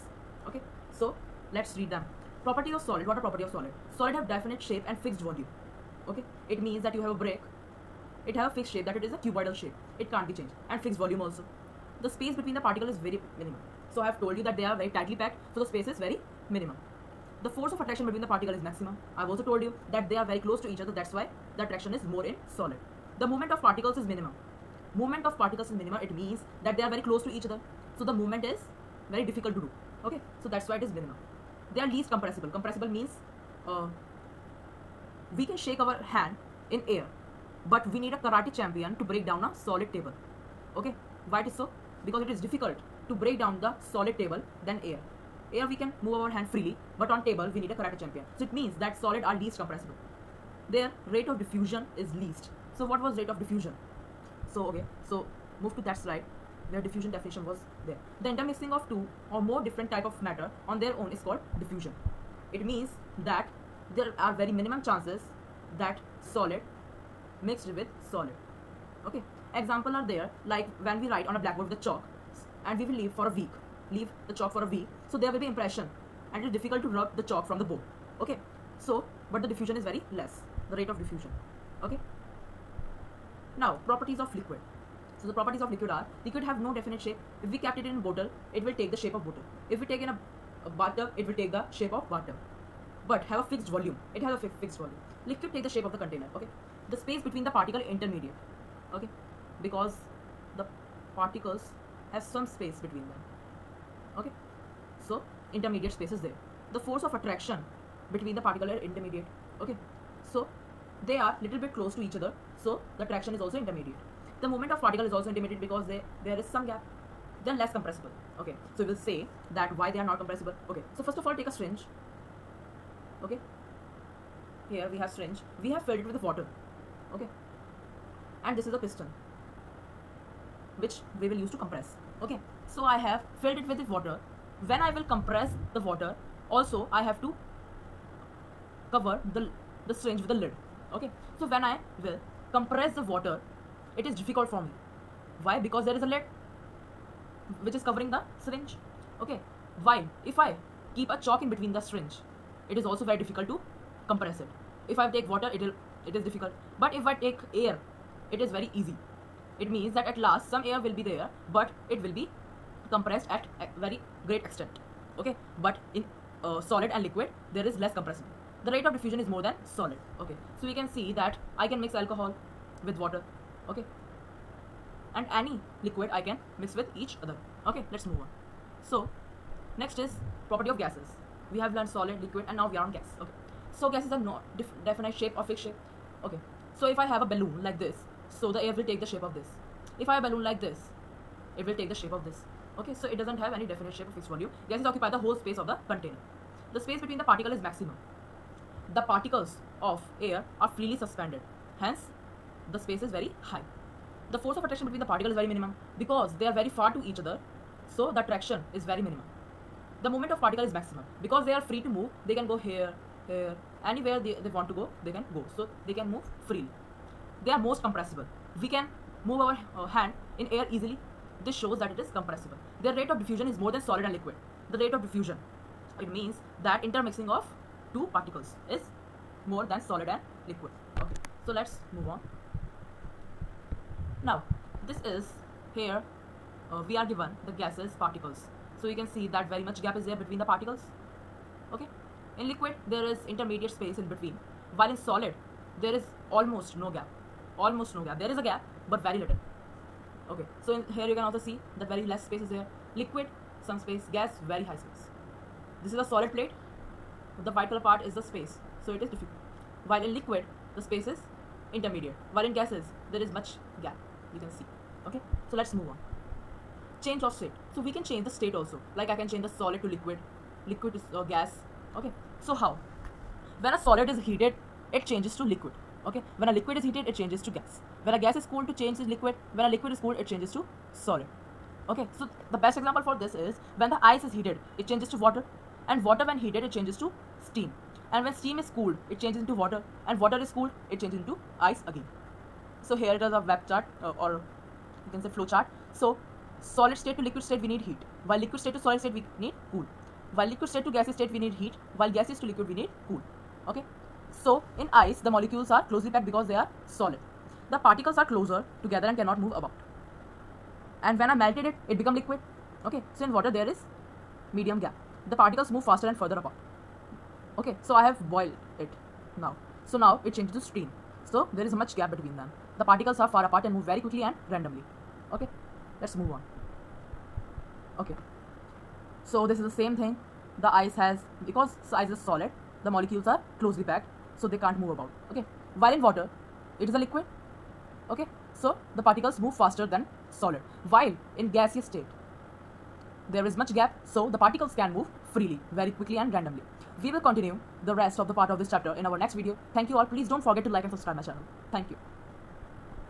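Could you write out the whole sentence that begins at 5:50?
Please don't forget to like and subscribe my channel.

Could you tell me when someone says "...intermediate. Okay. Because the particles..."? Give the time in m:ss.
1:37.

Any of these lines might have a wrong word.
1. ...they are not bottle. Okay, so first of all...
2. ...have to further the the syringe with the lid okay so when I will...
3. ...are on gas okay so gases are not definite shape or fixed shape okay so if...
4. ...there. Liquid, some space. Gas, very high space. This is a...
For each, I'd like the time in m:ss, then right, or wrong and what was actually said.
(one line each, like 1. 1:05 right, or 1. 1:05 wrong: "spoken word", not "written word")
1. 1:59 wrong: "compressible", not "bottle"
2. 2:17 wrong: "cover", not "further"
3. 3:02 right
4. 4:12 right.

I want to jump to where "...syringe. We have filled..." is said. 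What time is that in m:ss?
2:05.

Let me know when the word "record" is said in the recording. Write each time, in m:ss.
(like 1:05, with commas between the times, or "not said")
not said.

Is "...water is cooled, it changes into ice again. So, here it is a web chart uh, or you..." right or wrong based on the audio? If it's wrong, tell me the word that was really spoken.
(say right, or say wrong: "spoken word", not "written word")
right.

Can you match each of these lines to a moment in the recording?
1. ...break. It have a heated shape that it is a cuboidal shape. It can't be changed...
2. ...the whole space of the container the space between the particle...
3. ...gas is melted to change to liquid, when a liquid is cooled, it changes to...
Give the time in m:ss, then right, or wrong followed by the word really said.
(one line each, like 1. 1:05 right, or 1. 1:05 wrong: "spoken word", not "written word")
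1. 0:07 wrong: "fixed", not "heated"
2. 3:15 right
3. 4:38 wrong: "cooled", not "melted".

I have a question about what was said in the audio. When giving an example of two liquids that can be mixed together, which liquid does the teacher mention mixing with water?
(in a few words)
alcohol.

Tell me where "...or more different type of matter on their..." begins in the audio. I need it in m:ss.
0:59.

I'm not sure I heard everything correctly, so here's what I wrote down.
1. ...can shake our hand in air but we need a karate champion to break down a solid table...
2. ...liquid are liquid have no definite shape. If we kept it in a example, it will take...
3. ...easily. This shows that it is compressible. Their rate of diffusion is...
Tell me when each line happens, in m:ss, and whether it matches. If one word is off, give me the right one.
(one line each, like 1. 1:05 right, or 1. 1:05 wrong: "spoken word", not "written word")
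1. 0:35 right
2. 1:25 wrong: "bottle", not "example"
3. 3:40 right.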